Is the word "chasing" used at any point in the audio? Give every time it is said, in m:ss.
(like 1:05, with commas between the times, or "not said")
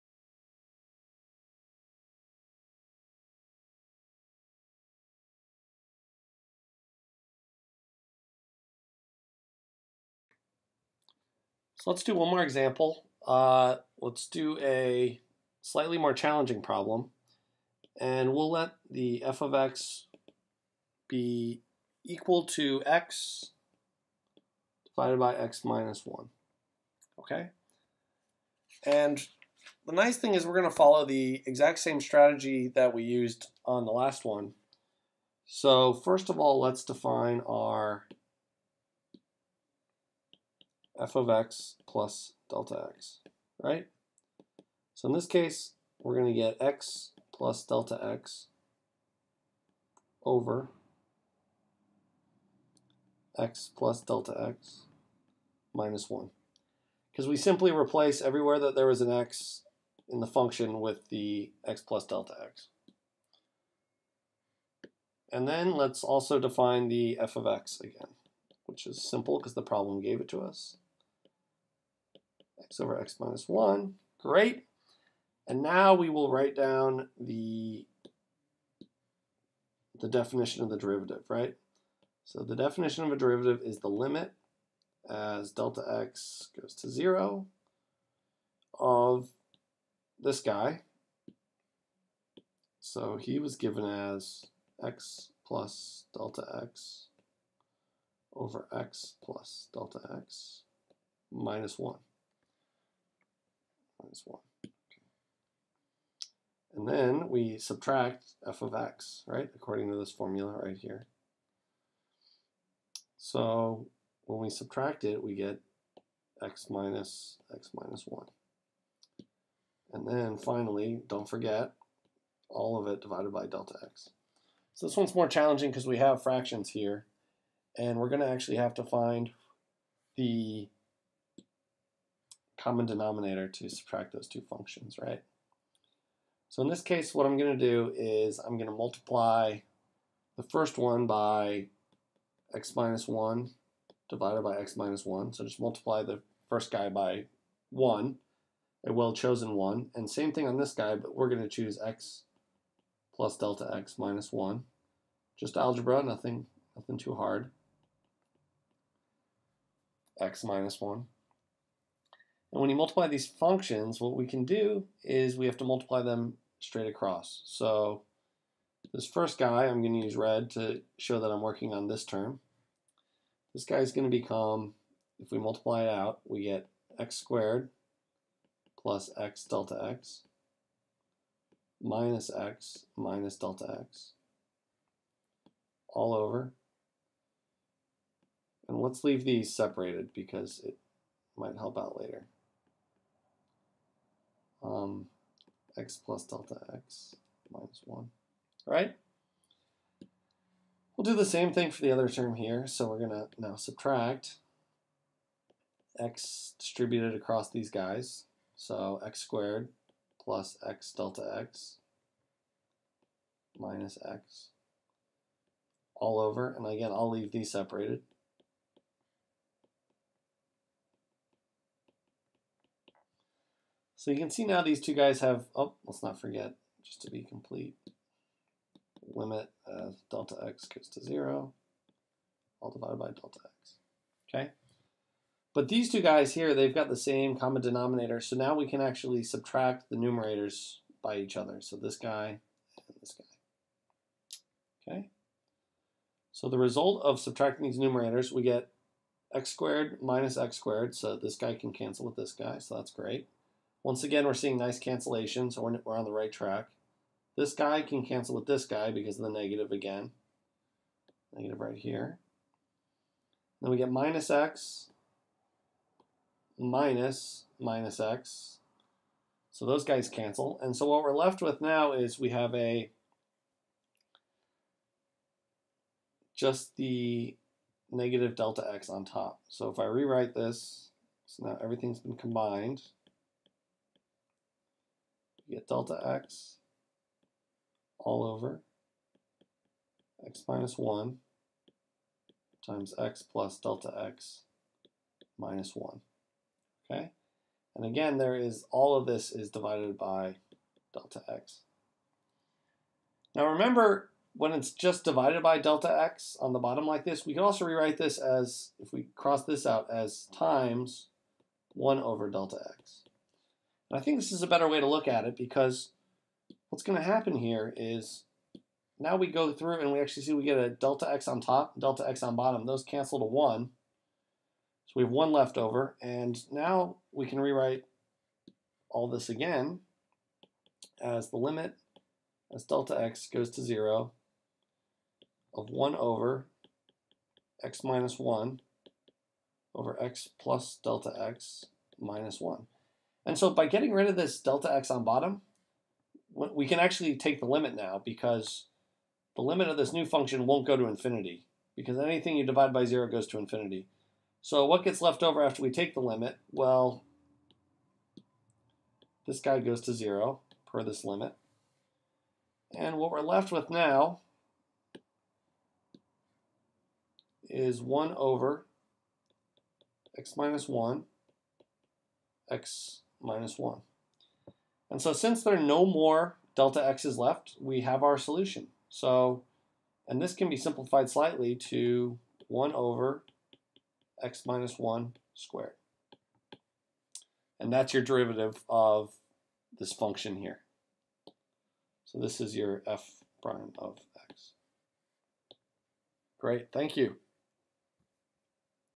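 not said.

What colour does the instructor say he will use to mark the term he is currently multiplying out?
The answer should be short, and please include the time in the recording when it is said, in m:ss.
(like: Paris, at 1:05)
Red, at 2:50.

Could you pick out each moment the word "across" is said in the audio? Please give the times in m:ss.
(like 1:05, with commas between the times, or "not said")
2:46, 3:27.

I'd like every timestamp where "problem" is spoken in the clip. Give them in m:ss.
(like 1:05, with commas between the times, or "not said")
0:16, 1:09.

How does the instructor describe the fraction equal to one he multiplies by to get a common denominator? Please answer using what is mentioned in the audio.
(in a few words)
a well-chosen 1.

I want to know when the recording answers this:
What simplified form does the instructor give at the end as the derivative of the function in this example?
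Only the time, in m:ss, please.
6:22.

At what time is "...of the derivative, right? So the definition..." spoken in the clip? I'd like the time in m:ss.
1:20.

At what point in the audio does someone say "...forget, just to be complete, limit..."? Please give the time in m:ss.
3:46.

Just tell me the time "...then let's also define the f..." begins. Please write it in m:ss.
1:05.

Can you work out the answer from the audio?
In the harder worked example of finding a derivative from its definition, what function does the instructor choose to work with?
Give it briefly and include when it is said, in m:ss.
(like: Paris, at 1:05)
x/(x-1), at 0:22.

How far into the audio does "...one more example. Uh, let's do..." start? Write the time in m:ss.
0:12.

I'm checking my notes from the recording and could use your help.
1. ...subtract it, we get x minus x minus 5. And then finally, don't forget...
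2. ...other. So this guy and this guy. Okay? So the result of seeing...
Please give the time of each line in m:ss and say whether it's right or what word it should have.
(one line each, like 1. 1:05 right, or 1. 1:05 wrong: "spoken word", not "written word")
1. 1:54 wrong: "1", not "5"
2. 4:01 wrong: "subtracting", not "seeing".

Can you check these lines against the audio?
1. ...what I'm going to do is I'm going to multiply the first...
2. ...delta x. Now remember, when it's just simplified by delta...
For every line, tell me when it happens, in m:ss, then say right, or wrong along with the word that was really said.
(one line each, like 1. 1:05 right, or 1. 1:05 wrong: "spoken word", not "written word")
1. 2:17 right
2. 5:00 wrong: "divided", not "simplified".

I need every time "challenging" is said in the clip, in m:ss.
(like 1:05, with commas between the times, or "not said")
0:16, 2:05.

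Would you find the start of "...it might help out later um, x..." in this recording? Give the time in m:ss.
3:10.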